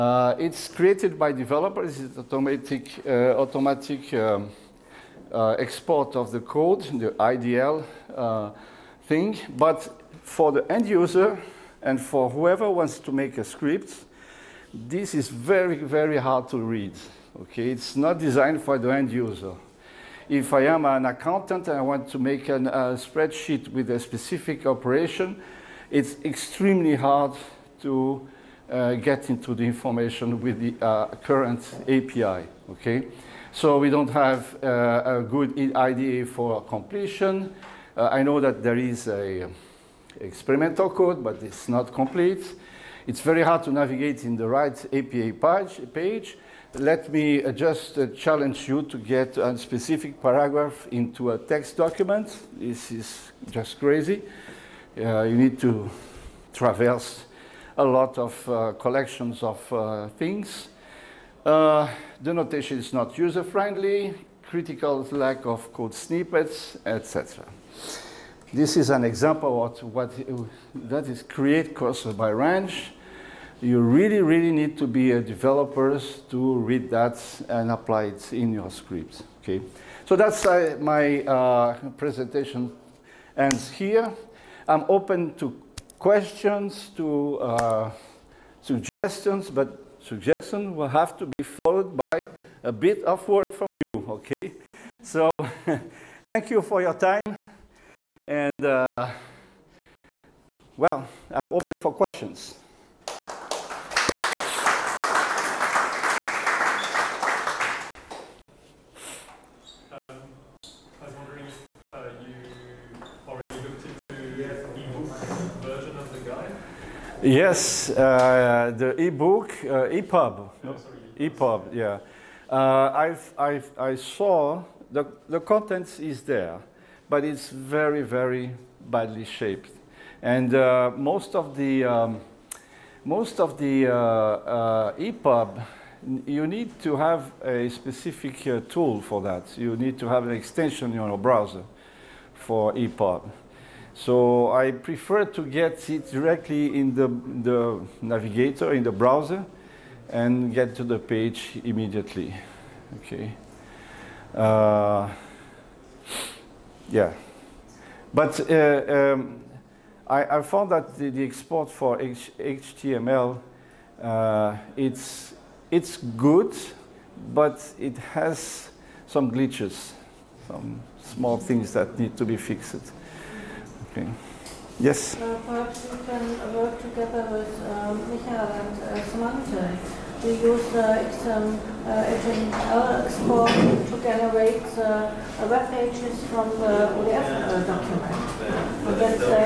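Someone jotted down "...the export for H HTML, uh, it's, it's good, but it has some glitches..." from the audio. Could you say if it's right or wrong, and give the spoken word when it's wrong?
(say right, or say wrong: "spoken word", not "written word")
right.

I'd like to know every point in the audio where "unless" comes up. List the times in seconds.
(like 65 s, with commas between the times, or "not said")
not said.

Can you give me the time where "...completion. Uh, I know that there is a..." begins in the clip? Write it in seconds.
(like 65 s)
36 s.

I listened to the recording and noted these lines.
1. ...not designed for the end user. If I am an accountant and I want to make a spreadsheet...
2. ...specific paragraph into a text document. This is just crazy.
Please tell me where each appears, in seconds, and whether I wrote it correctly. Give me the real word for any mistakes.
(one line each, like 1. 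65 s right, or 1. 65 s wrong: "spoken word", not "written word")
1. 17 s right
2. 49 s right.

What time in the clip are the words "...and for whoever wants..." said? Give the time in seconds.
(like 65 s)
11 s.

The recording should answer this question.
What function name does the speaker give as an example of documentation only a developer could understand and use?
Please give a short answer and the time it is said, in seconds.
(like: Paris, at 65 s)
create cursor by range, at 71 s.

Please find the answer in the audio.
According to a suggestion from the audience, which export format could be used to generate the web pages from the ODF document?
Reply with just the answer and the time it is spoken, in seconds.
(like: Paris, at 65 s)
XML, at 181 s.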